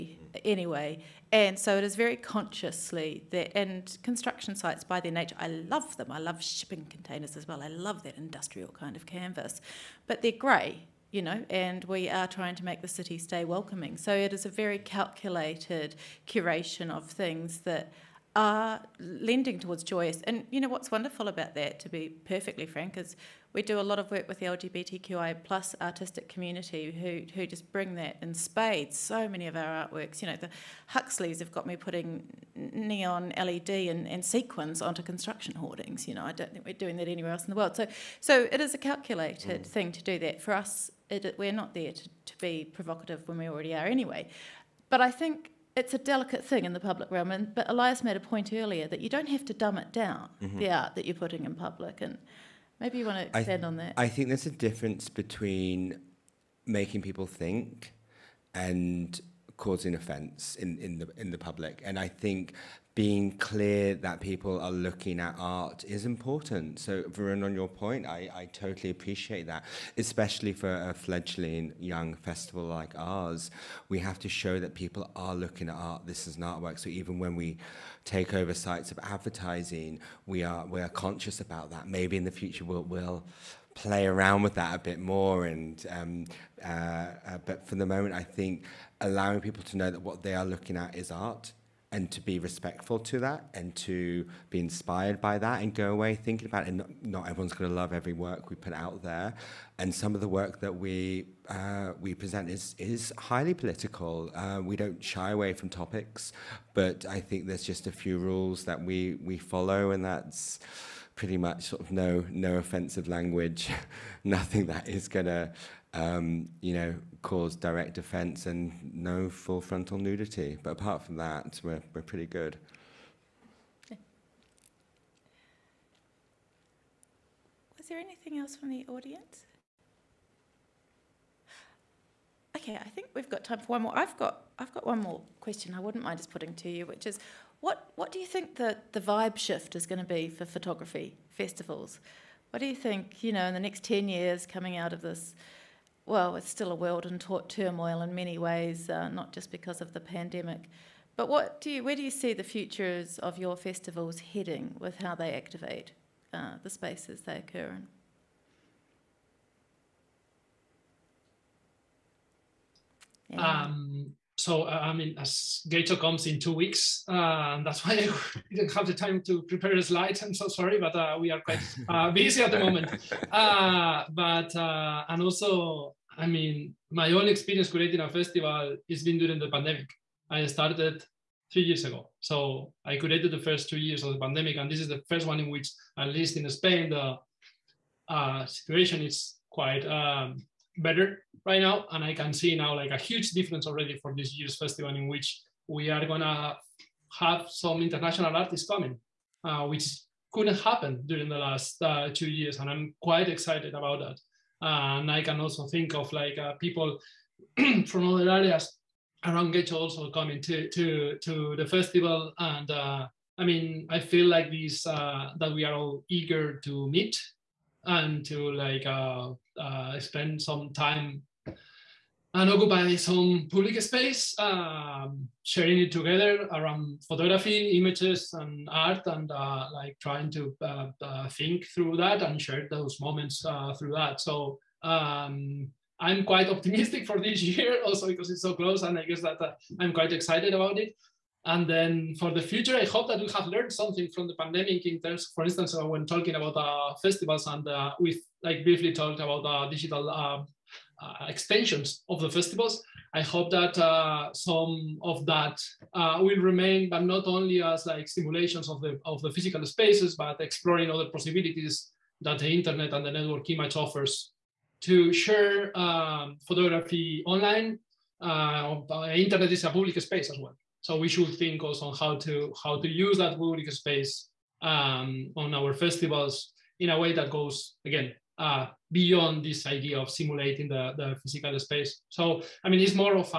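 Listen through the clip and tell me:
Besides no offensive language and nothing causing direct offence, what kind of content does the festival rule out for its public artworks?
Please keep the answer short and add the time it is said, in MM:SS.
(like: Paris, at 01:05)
Full frontal nudity, at 01:59.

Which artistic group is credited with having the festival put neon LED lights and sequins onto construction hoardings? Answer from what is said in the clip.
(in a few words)
The Huxleys.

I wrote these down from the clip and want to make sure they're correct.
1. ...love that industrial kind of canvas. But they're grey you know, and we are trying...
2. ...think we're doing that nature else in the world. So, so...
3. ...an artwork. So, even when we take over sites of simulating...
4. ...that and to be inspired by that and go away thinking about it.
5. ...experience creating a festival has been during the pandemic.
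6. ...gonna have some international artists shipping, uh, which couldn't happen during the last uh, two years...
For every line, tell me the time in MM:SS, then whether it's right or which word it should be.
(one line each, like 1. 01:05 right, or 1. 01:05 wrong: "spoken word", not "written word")
1. 00:07 right
2. 00:36 wrong: "anywhere", not "nature"
3. 01:16 wrong: "advertising", not "simulating"
4. 01:33 right
5. 02:57 right
6. 03:16 wrong: "coming", not "shipping".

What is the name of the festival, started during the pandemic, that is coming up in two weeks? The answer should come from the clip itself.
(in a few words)
Getxo.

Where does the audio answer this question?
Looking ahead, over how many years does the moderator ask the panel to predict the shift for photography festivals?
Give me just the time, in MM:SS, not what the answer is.
02:23.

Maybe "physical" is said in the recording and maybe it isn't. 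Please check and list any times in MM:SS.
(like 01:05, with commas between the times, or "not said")
04:19, 04:41.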